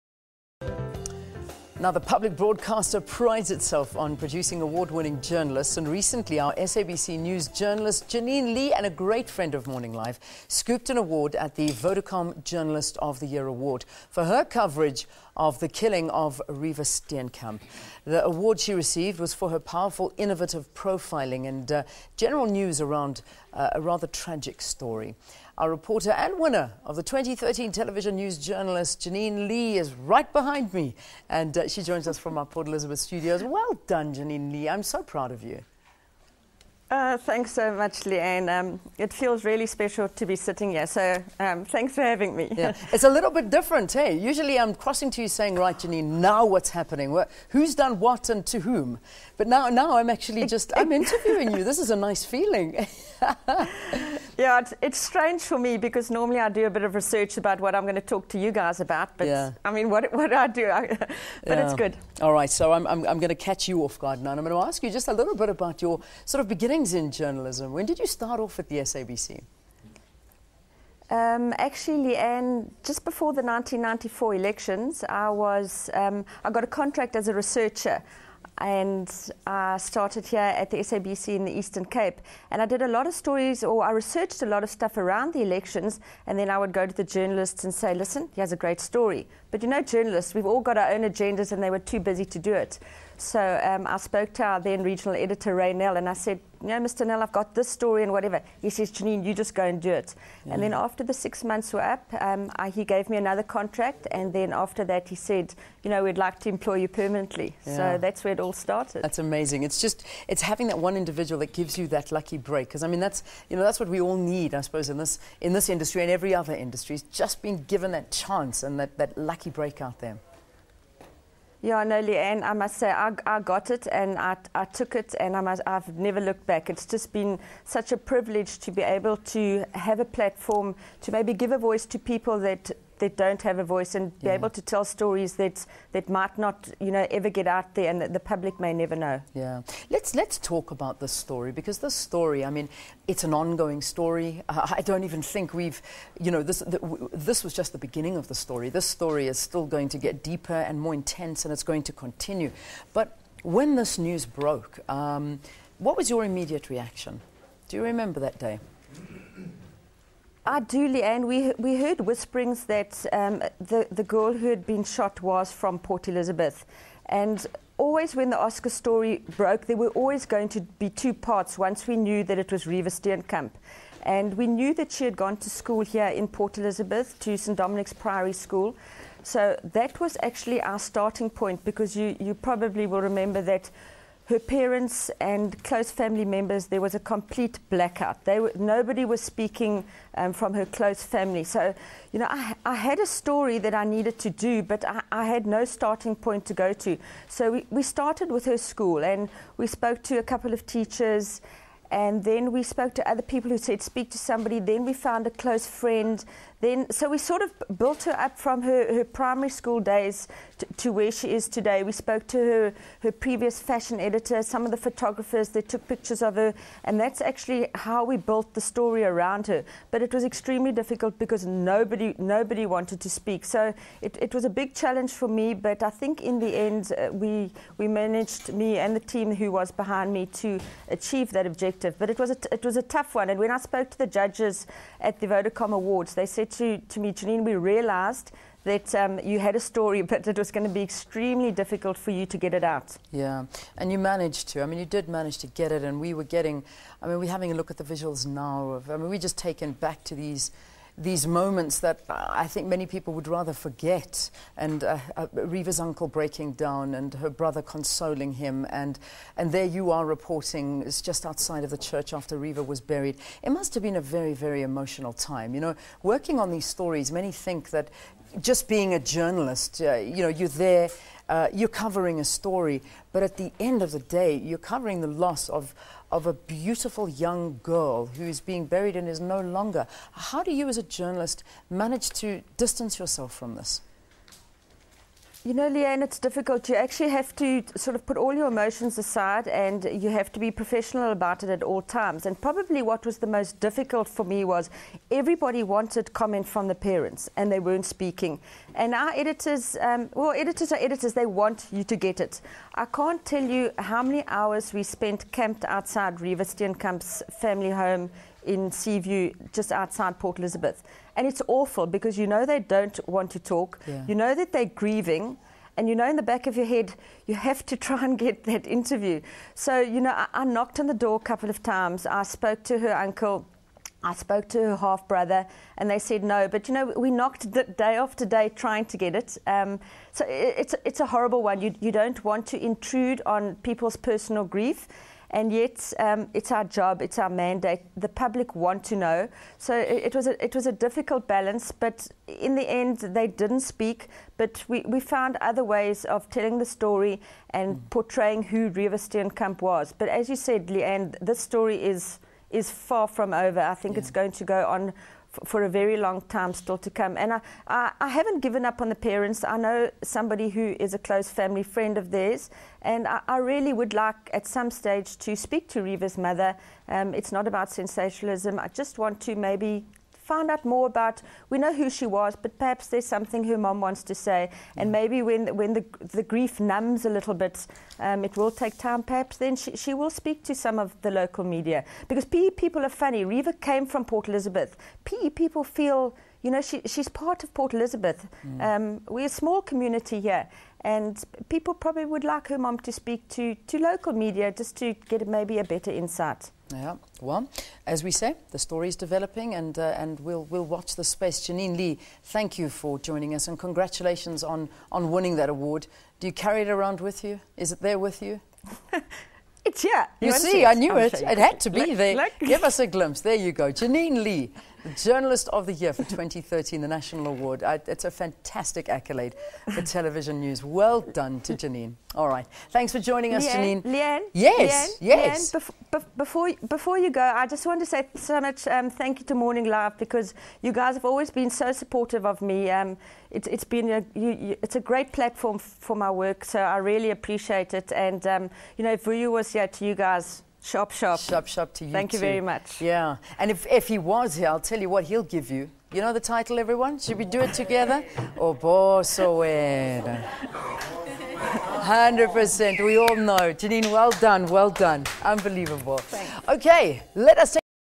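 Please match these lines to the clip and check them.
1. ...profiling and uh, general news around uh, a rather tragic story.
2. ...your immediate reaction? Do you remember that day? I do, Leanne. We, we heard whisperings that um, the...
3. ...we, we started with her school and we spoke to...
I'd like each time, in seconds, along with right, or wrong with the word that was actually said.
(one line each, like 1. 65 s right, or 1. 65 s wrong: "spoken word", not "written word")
1. 20 s right
2. 156 s right
3. 197 s right.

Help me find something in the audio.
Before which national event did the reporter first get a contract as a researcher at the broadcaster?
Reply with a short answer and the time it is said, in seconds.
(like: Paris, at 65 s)
1994 elections, at 73 s.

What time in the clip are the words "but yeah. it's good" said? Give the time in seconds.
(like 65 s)
60 s.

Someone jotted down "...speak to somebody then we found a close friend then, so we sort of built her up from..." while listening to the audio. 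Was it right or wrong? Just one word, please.
right.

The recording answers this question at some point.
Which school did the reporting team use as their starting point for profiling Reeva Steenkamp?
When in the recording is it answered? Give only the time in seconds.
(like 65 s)
177 s.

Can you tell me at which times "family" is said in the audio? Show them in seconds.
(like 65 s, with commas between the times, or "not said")
185 s, 191 s, 307 s, 361 s.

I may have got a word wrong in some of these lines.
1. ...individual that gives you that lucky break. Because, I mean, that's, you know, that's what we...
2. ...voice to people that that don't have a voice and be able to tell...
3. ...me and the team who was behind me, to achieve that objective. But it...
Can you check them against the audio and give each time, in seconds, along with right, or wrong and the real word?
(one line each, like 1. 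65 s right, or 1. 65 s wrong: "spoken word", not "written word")
1. 110 s right
2. 131 s right
3. 228 s right.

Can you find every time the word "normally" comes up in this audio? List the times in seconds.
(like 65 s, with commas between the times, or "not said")
56 s.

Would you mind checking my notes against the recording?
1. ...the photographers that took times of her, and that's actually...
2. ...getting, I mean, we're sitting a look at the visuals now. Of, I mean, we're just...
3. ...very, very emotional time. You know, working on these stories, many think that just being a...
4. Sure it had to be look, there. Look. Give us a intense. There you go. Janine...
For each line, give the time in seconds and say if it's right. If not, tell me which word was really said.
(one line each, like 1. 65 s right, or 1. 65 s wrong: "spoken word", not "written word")
1. 214 s wrong: "pictures", not "times"
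2. 246 s wrong: "having", not "sitting"
3. 264 s right
4. 411 s wrong: "glimpse", not "intense".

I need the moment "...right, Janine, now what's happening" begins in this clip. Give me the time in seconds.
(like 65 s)
45 s.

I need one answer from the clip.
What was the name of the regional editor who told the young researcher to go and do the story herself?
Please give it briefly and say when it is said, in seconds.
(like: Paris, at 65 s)
Ray Nell, at 95 s.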